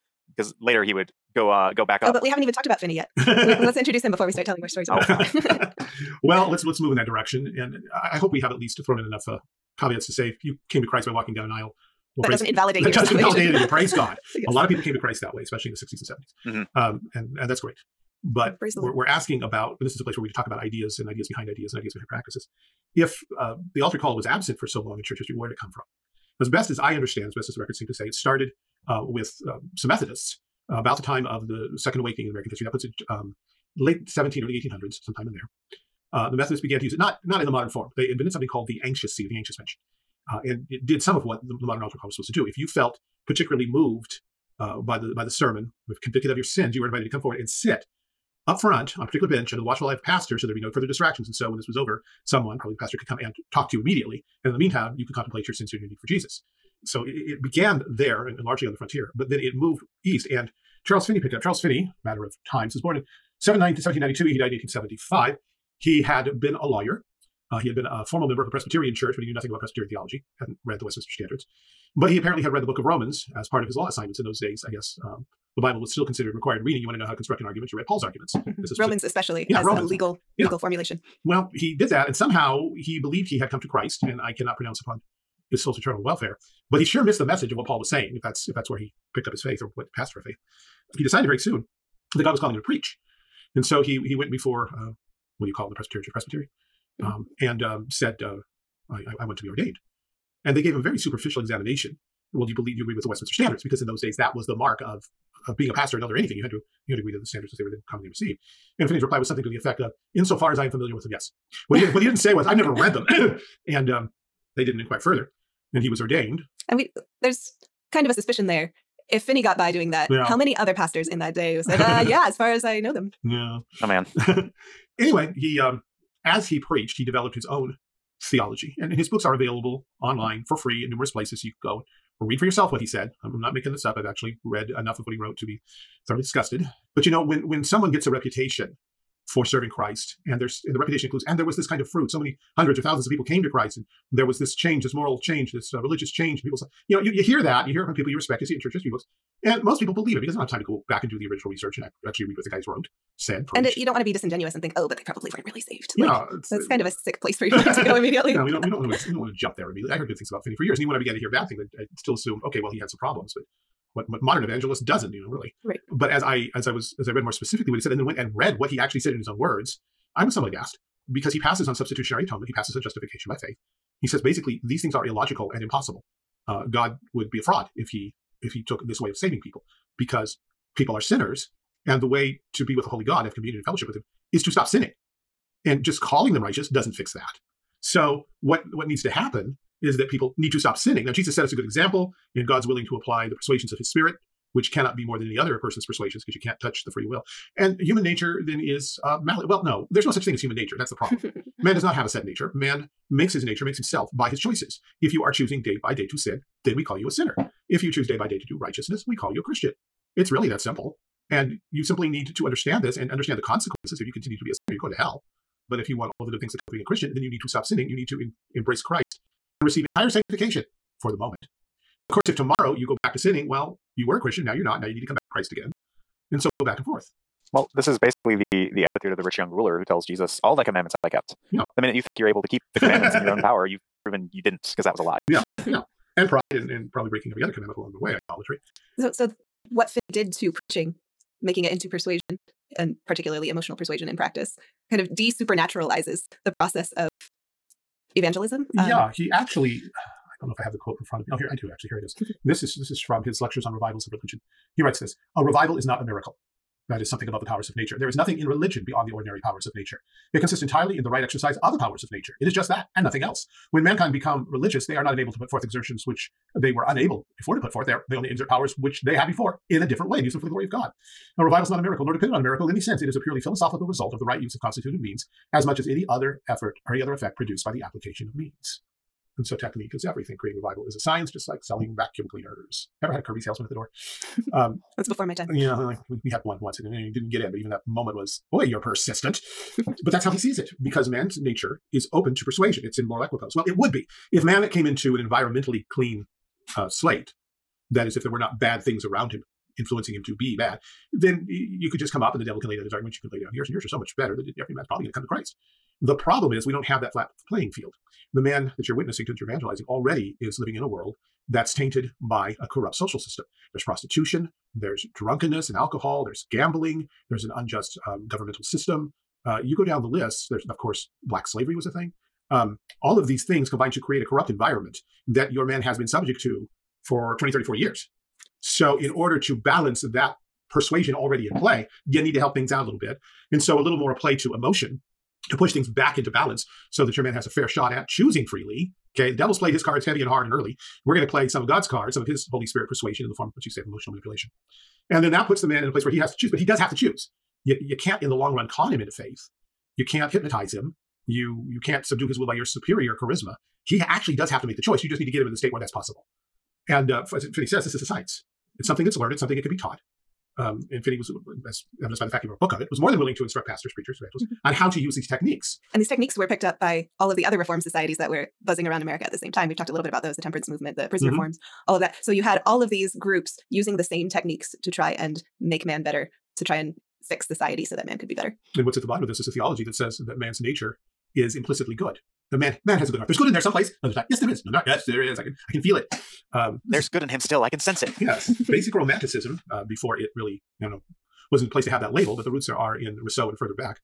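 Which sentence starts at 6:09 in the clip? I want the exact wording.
We've talked a little bit about those the temperance movement, the prison mm-hmm.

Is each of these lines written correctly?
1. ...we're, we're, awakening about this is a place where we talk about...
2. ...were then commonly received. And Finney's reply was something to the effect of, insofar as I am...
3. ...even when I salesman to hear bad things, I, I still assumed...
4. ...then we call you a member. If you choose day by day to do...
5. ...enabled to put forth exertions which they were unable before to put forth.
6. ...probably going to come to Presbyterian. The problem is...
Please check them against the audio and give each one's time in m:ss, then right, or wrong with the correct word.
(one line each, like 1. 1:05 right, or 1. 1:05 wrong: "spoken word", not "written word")
1. 0:18 wrong: "asking", not "awakening"
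2. 1:47 right
3. 2:40 wrong: "began", not "salesman"
4. 3:26 wrong: "sinner", not "member"
5. 4:25 right
6. 5:04 wrong: "Christ", not "Presbyterian".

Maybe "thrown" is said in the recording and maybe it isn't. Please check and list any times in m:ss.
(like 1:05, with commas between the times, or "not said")
0:08.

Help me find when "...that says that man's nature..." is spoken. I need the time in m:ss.
6:19.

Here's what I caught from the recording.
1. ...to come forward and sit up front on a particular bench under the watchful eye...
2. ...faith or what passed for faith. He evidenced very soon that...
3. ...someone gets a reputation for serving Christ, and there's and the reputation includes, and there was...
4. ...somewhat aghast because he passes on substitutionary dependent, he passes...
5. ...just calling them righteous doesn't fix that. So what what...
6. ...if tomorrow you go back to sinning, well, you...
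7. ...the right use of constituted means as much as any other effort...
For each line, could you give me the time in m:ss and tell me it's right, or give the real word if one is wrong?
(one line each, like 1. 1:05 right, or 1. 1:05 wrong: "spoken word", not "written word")
1. 0:47 right
2. 1:29 wrong: "decided", not "evidenced"
3. 2:17 right
4. 2:50 wrong: "atonement", not "dependent"
5. 3:05 right
6. 3:42 right
7. 4:34 right.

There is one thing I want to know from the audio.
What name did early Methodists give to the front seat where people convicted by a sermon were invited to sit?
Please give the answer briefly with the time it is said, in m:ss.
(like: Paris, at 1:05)
anxious bench, at 0:39.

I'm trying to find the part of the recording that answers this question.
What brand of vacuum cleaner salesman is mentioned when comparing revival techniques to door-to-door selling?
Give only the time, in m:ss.
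4:43.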